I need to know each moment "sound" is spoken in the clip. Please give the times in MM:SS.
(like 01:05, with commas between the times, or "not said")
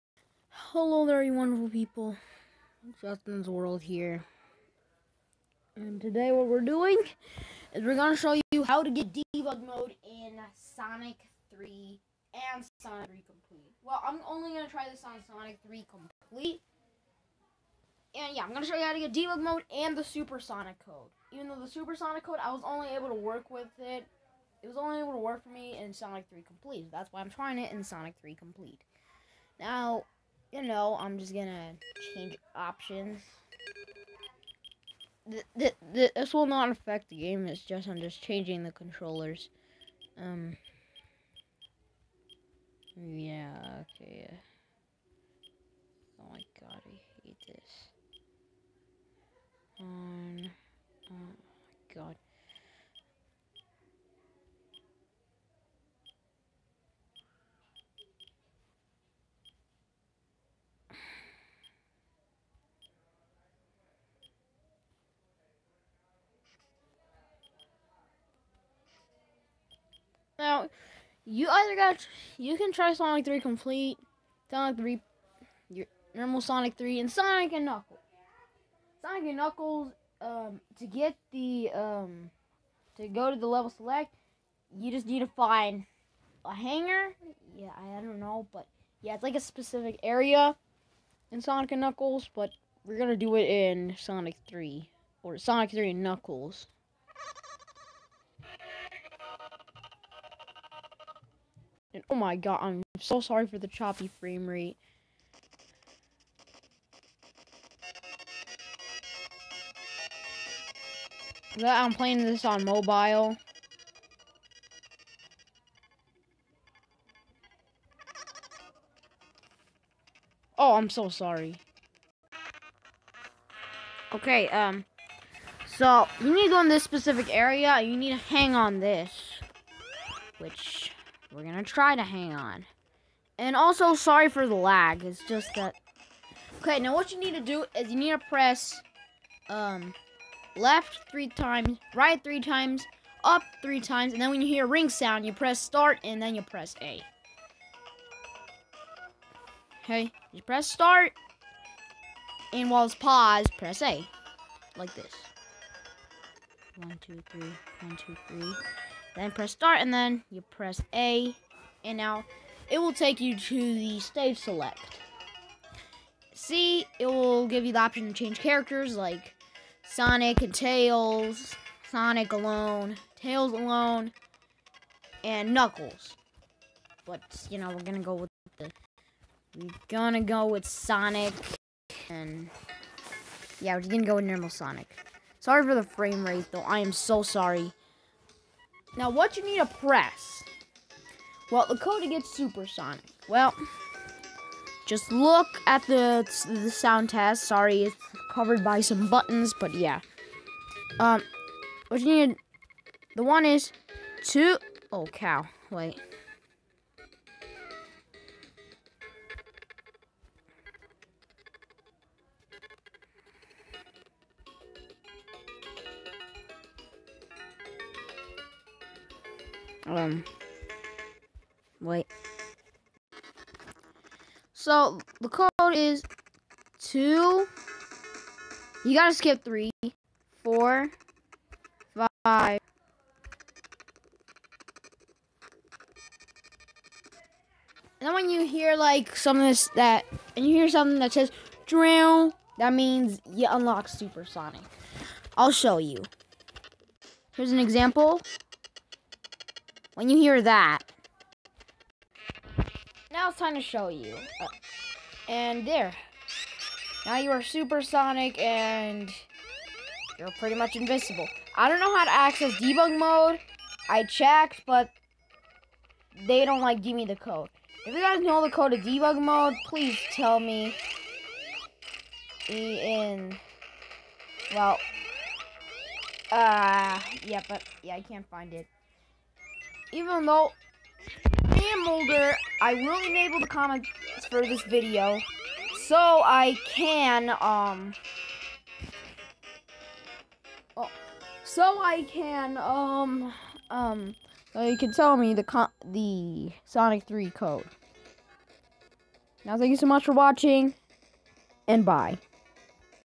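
02:24, 03:16.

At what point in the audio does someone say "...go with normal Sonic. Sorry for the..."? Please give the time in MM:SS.
03:04.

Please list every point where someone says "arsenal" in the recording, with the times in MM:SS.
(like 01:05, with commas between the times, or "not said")
not said.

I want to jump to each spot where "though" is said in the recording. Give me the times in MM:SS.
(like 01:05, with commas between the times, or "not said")
00:21, 03:06, 04:40.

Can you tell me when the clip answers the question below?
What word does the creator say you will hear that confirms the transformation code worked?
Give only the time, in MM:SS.
04:01.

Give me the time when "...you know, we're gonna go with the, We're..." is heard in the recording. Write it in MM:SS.
02:57.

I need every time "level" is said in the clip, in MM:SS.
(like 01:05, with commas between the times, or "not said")
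01:23.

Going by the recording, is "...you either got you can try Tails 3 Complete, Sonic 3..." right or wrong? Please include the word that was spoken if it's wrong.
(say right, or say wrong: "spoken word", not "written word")
wrong: "Sonic", not "Tails".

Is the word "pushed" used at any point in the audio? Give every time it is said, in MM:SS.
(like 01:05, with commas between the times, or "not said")
not said.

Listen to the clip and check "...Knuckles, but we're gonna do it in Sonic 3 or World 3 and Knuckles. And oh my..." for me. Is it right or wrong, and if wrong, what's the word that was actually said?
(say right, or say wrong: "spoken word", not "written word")
wrong: "Sonic", not "World".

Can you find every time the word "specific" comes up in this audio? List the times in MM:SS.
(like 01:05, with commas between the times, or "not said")
01:29, 02:06.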